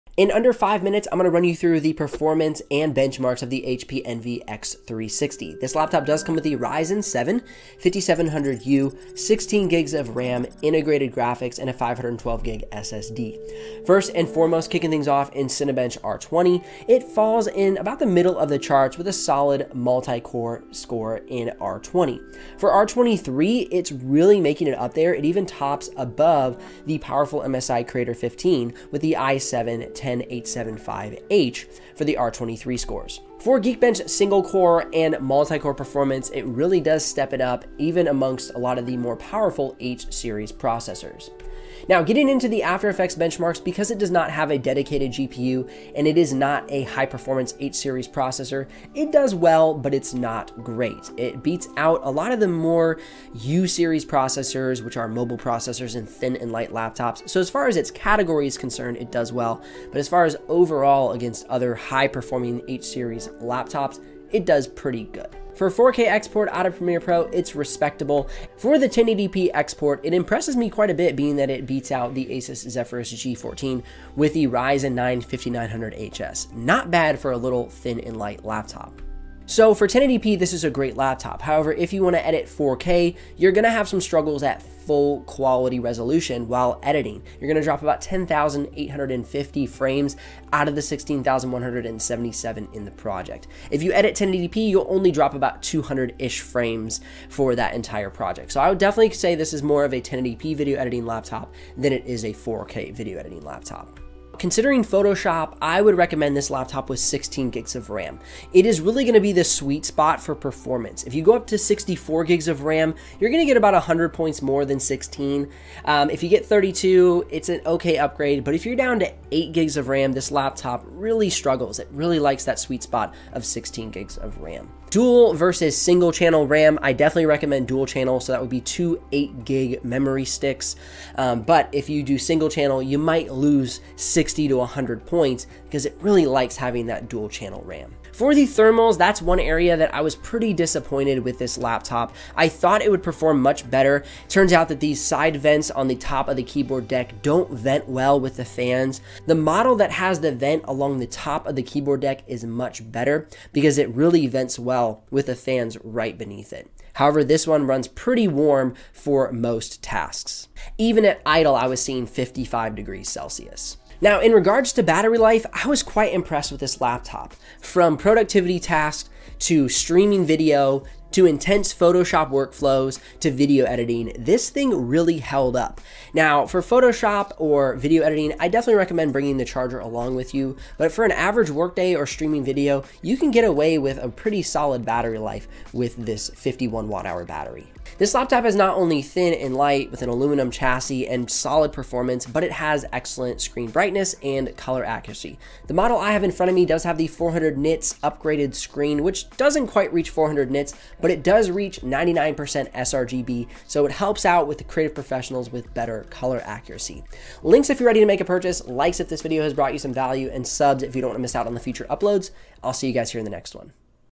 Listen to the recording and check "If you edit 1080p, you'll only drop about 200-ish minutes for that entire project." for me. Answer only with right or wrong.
wrong.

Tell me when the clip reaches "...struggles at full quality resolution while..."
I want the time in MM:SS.
01:23.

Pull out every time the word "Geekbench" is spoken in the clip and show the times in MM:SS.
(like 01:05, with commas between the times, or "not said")
00:33.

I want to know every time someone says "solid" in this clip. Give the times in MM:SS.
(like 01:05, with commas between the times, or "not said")
00:19, 03:04, 03:11.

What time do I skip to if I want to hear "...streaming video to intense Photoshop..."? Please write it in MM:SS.
02:49.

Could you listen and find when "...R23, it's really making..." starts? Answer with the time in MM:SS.
00:22.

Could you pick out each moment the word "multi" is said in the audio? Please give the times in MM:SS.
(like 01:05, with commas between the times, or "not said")
00:19, 00:35.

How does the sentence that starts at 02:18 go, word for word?
For the thermals, that's one area that I was pretty disappointed with this laptop.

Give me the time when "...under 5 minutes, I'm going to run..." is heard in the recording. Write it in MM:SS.
00:00.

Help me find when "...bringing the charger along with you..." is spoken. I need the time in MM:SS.
02:59.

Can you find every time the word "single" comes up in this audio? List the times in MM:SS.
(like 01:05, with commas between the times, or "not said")
00:34, 02:05, 02:12.